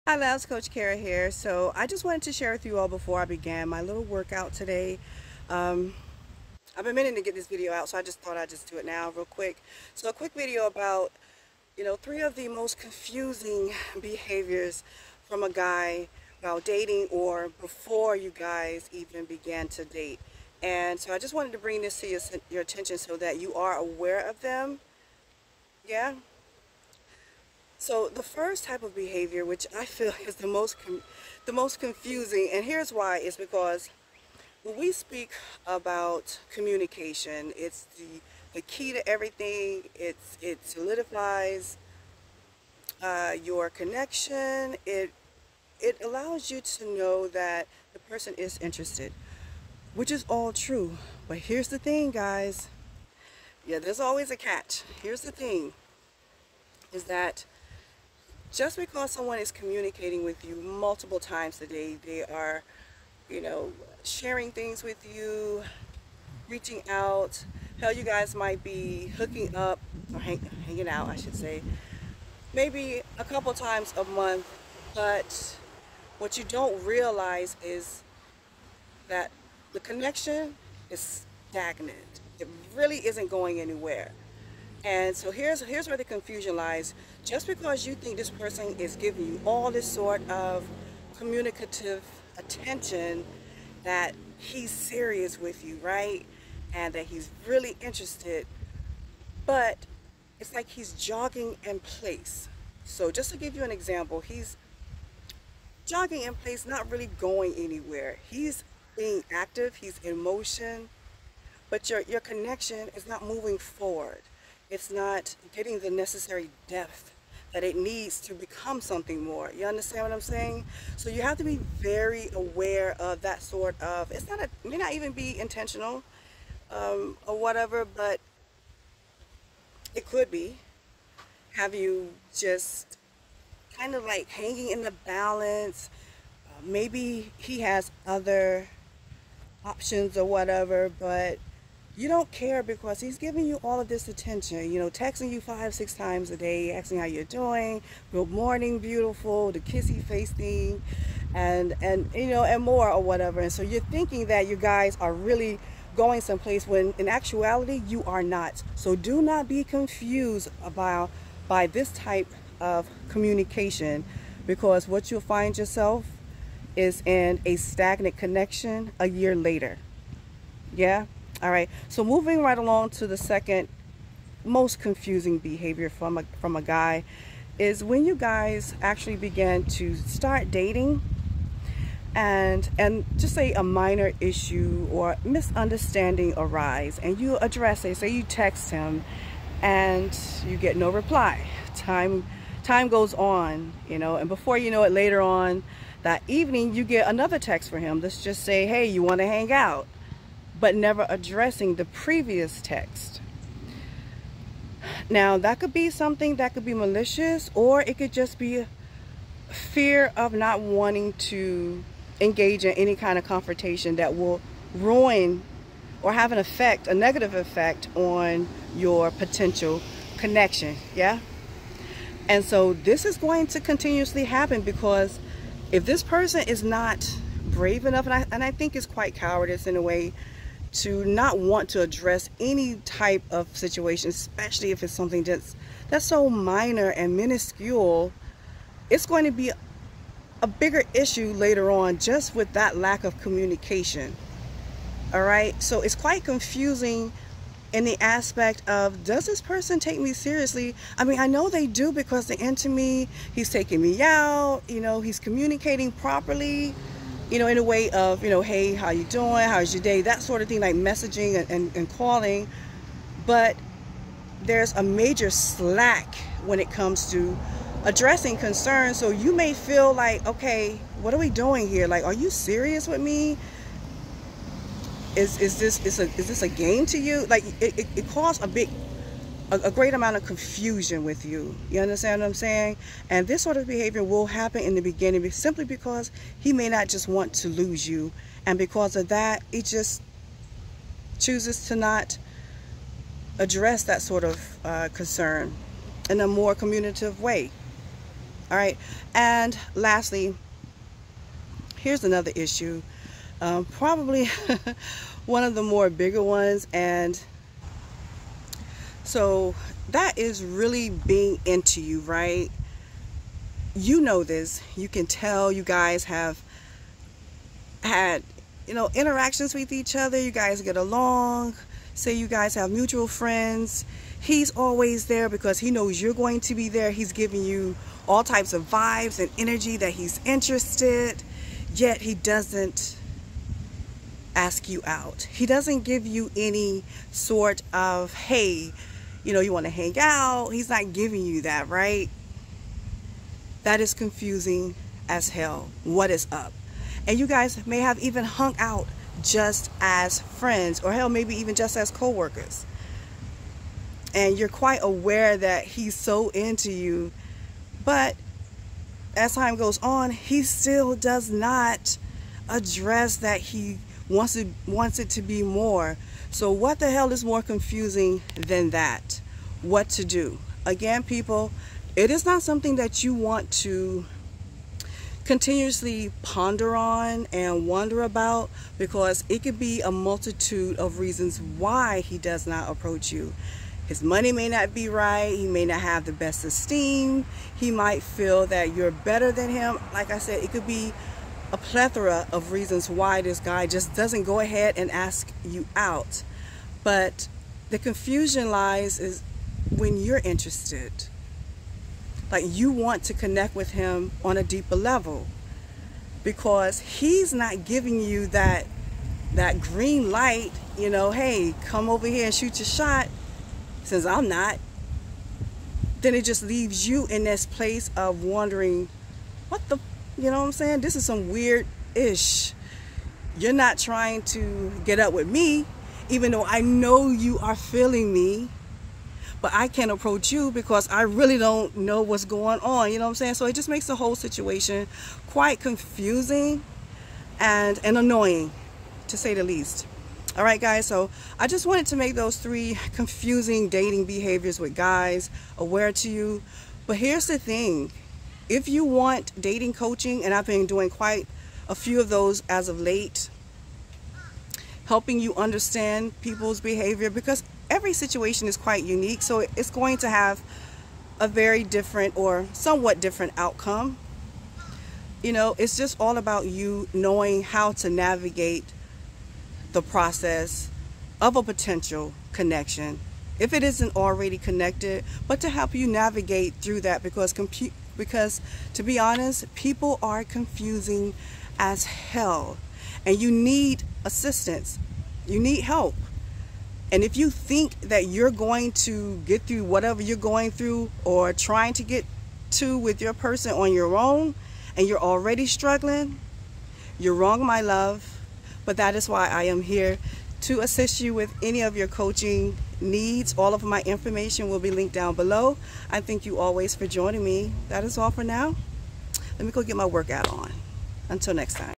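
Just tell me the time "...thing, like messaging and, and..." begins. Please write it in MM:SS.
04:20.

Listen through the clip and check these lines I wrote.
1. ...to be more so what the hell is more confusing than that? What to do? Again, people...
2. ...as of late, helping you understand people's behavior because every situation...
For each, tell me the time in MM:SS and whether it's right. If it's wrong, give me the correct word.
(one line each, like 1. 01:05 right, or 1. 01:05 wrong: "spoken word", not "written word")
1. 06:05 right
2. 07:32 right.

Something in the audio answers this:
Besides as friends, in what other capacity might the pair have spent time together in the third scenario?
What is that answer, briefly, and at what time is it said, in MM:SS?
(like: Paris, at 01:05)
coworkers, at 05:51.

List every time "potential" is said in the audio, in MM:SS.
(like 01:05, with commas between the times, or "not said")
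03:39, 07:51.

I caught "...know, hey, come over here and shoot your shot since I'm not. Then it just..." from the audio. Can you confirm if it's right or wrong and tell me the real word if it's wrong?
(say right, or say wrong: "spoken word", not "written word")
right.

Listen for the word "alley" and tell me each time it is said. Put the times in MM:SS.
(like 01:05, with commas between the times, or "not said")
not said.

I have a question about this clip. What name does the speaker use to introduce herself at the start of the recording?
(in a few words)
Coach Kera.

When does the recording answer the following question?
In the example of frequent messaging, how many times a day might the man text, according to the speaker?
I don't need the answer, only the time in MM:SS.
02:25.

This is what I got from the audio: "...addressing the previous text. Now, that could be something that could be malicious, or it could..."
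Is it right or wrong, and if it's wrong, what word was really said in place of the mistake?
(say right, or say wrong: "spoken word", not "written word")
right.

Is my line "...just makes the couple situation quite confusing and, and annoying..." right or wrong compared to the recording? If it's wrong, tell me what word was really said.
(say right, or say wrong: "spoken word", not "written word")
wrong: "whole", not "couple".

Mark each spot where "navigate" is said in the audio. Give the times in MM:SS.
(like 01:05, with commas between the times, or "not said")
07:47, 07:55.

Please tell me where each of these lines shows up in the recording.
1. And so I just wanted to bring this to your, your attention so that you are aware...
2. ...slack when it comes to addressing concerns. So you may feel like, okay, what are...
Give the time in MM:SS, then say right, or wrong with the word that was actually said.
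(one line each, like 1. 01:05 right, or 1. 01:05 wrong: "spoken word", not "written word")
1. 00:20 right
2. 04:25 right.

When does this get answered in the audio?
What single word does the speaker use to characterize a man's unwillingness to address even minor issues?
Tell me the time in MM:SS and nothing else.
03:49.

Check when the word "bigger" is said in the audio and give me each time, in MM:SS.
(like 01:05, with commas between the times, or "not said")
04:00, 05:05.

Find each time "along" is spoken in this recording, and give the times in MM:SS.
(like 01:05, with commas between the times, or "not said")
02:52, 05:20.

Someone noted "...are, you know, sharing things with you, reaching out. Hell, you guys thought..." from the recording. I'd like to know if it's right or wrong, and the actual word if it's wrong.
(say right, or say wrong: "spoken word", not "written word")
wrong: "might", not "thought".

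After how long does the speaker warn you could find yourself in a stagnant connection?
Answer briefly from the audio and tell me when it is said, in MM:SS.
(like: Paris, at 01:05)
a year, at 02:48.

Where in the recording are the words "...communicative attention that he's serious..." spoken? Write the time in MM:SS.
01:31.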